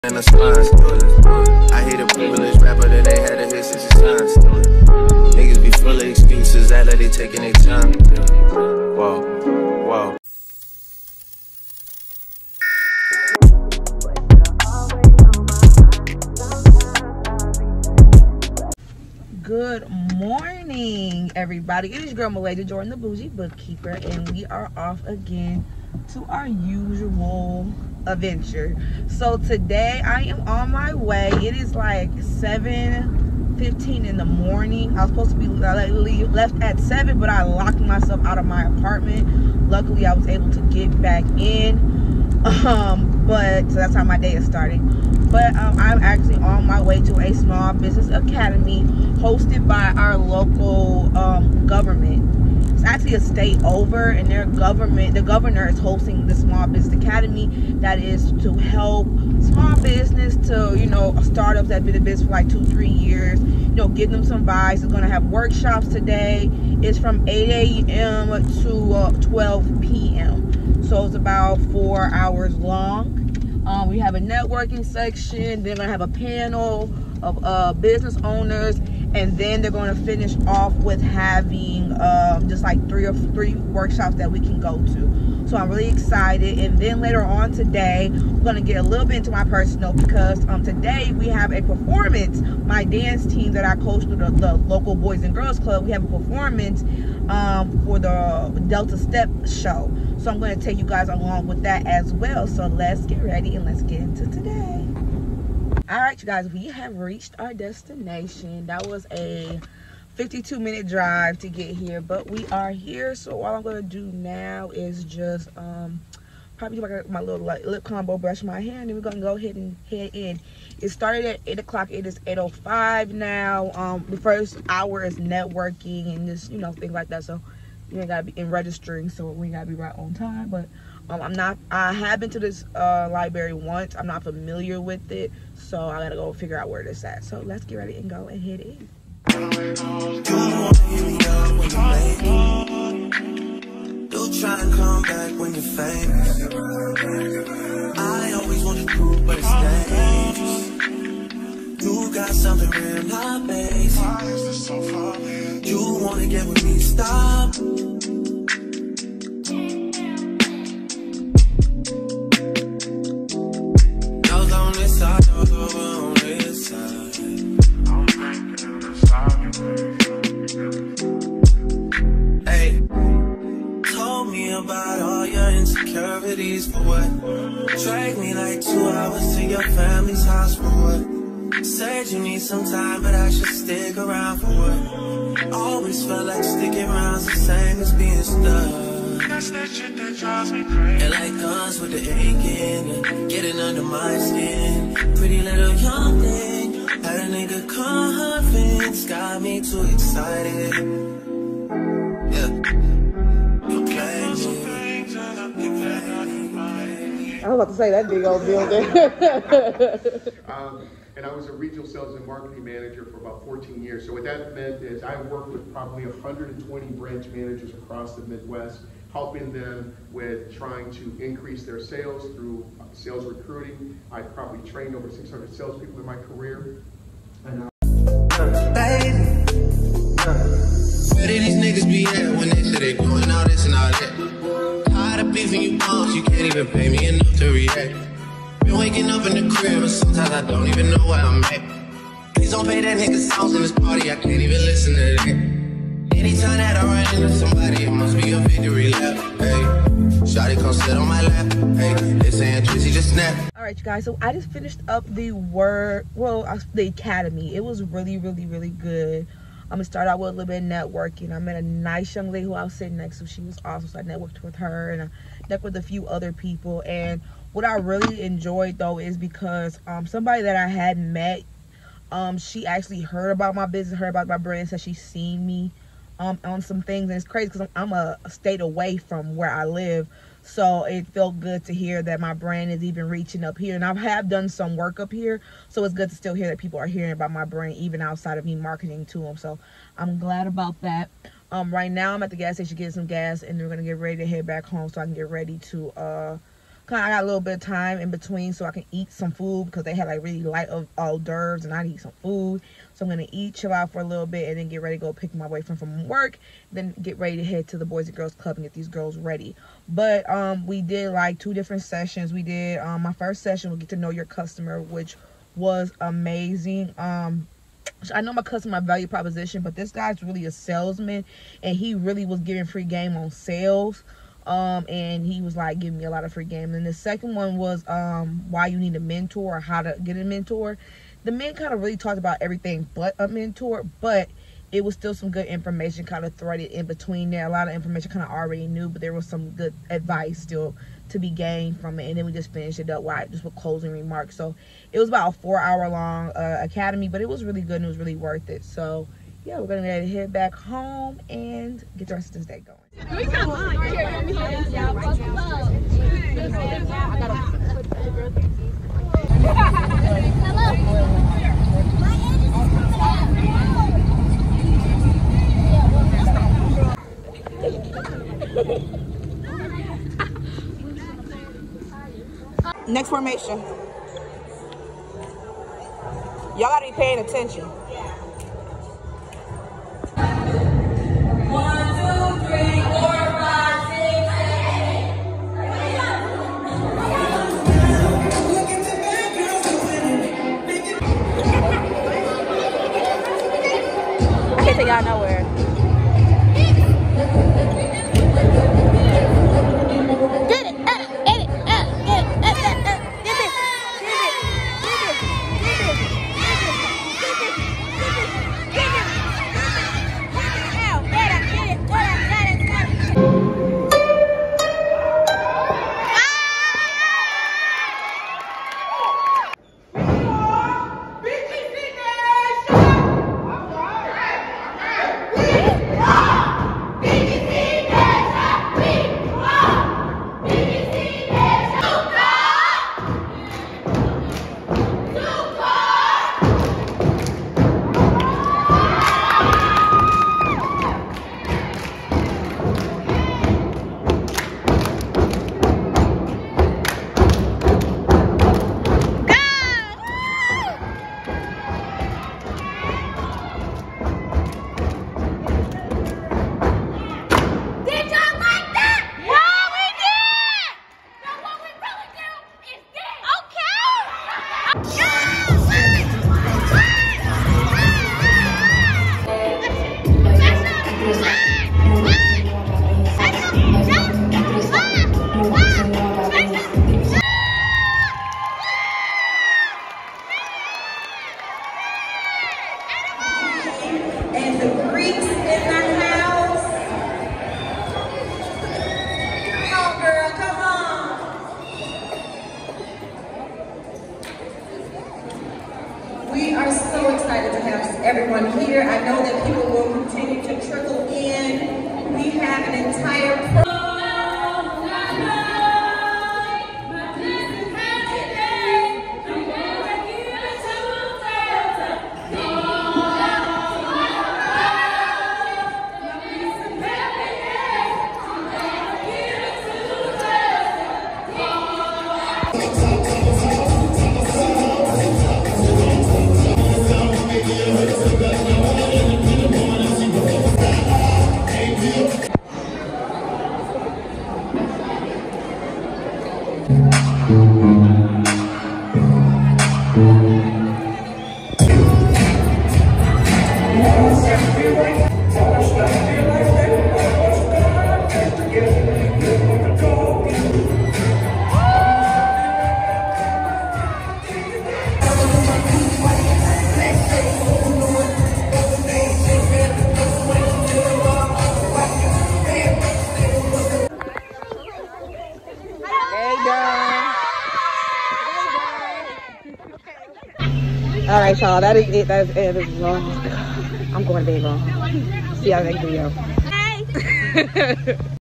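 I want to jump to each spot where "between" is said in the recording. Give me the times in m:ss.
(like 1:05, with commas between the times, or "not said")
4:58, 5:36.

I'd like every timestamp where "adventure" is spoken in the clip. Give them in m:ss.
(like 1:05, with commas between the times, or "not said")
0:28.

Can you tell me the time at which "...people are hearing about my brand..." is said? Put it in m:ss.
4:46.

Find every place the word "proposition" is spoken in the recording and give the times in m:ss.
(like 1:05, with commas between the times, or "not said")
5:19.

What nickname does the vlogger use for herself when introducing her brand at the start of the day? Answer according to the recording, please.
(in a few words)
The Boujee Bookkeeper.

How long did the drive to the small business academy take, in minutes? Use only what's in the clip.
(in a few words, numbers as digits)
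52.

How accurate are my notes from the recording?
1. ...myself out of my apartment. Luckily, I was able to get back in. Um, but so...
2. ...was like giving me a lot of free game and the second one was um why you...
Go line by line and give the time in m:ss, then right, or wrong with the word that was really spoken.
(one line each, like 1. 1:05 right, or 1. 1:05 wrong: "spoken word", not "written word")
1. 0:37 right
2. 5:25 right.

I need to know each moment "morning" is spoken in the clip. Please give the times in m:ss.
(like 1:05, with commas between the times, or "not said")
0:20, 0:34.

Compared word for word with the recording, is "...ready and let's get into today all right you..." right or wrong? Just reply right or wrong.
right.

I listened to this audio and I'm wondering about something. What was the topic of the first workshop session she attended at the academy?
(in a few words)
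Get to know your customer.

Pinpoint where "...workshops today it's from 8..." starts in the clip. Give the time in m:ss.
1:05.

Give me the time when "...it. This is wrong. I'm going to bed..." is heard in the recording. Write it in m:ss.
9:32.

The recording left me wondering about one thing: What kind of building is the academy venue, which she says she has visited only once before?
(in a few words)
Library.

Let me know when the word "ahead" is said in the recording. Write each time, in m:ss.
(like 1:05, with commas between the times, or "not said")
1:59.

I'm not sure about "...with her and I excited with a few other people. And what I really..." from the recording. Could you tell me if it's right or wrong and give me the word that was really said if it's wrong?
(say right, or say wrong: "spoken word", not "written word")
wrong: "networked", not "excited".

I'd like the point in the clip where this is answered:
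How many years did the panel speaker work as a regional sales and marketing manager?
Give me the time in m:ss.
3:33.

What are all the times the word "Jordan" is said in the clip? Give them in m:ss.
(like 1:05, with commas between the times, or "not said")
0:22.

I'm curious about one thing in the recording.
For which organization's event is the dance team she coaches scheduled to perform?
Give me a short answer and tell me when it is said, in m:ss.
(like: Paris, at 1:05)
Delta step show, at 1:37.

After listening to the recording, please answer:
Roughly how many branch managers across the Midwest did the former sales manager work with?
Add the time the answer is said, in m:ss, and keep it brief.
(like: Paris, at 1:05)
120, at 3:36.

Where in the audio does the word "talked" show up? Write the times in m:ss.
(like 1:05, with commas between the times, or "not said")
5:31.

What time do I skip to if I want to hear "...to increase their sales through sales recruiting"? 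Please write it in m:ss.
3:40.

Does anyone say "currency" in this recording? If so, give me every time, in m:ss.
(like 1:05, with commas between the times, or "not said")
not said.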